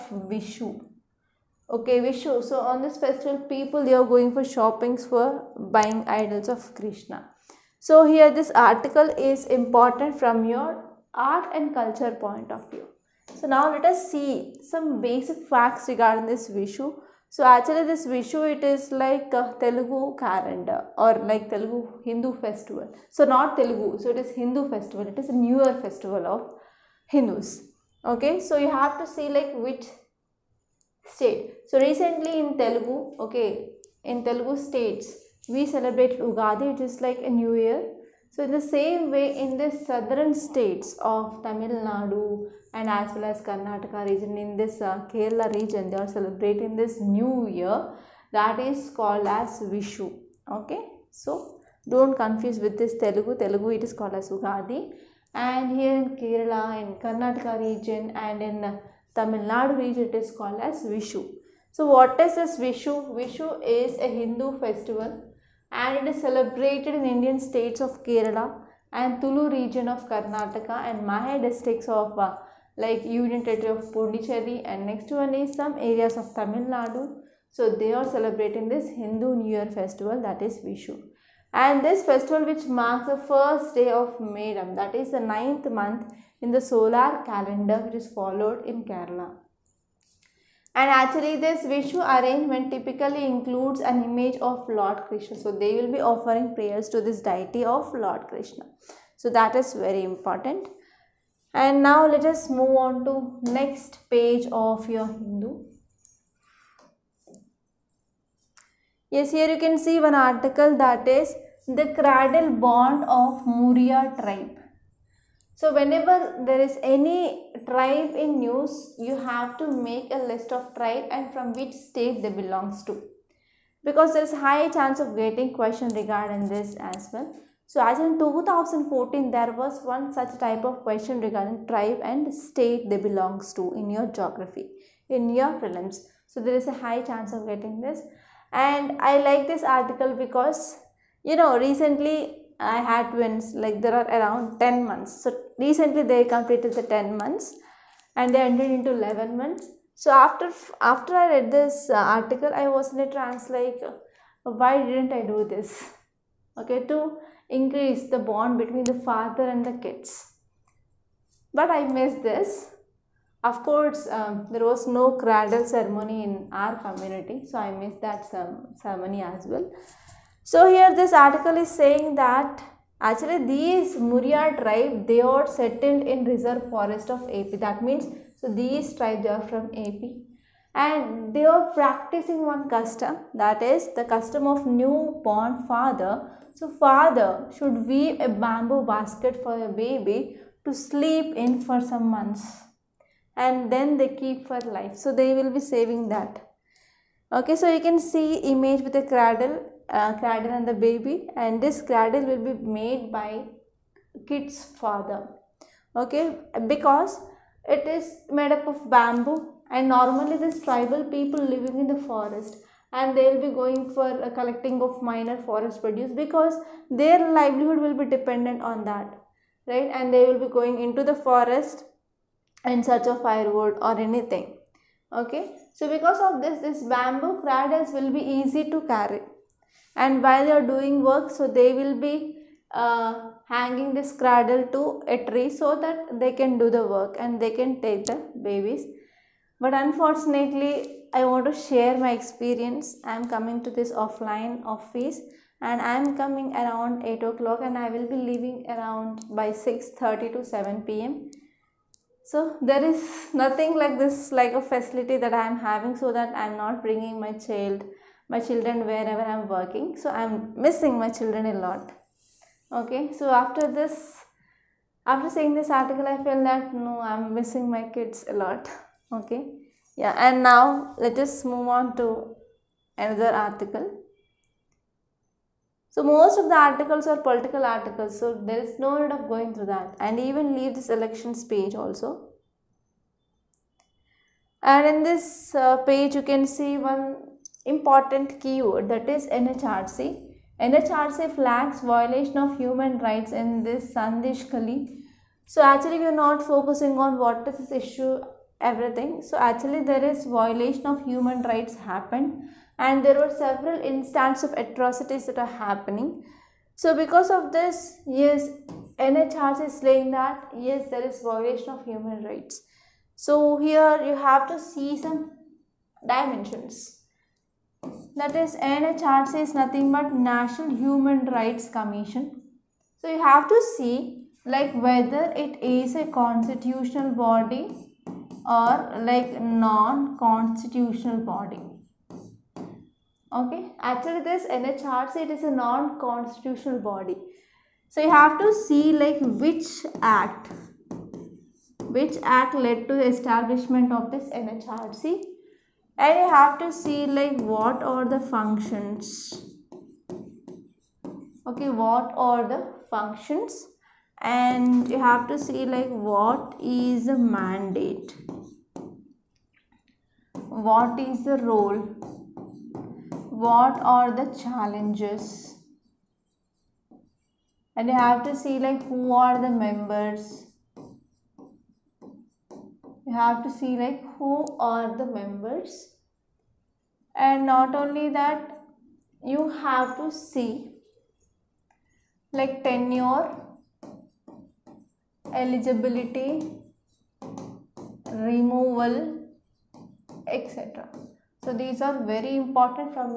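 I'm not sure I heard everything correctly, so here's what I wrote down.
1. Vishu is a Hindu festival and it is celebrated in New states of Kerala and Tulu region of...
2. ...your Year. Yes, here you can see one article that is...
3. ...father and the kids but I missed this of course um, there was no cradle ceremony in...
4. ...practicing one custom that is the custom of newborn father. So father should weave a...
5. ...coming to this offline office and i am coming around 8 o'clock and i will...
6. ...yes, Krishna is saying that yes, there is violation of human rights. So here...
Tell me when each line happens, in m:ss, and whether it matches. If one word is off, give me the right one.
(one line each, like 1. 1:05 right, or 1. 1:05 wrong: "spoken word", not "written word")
1. 1:03 wrong: "Indian", not "New"
2. 1:44 wrong: "Hindu", not "Year"
3. 2:39 right
4. 3:01 right
5. 4:03 right
6. 5:08 wrong: "NHRC", not "Krishna".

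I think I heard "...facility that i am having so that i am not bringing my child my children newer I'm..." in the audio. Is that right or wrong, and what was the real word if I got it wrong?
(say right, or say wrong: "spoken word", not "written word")
wrong: "wherever", not "newer".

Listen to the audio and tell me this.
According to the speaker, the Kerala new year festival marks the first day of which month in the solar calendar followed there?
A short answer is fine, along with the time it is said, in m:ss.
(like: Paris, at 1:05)
Medam, at 1:24.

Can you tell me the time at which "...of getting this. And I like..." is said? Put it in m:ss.
2:17.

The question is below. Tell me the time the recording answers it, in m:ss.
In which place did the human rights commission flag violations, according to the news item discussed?
4:53.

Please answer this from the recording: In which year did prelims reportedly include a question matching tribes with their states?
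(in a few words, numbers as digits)
2014.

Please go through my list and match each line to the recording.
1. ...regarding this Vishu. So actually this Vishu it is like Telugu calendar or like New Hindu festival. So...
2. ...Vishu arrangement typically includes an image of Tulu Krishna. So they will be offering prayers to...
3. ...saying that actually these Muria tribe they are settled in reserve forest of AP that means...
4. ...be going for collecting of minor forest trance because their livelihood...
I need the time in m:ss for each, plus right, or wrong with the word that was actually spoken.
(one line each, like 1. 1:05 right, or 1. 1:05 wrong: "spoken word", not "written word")
1. 0:15 wrong: "Telugu", not "New"
2. 1:31 wrong: "Lord", not "Tulu"
3. 2:51 right
4. 3:33 wrong: "produce", not "trance".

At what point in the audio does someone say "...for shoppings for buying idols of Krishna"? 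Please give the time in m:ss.
0:04.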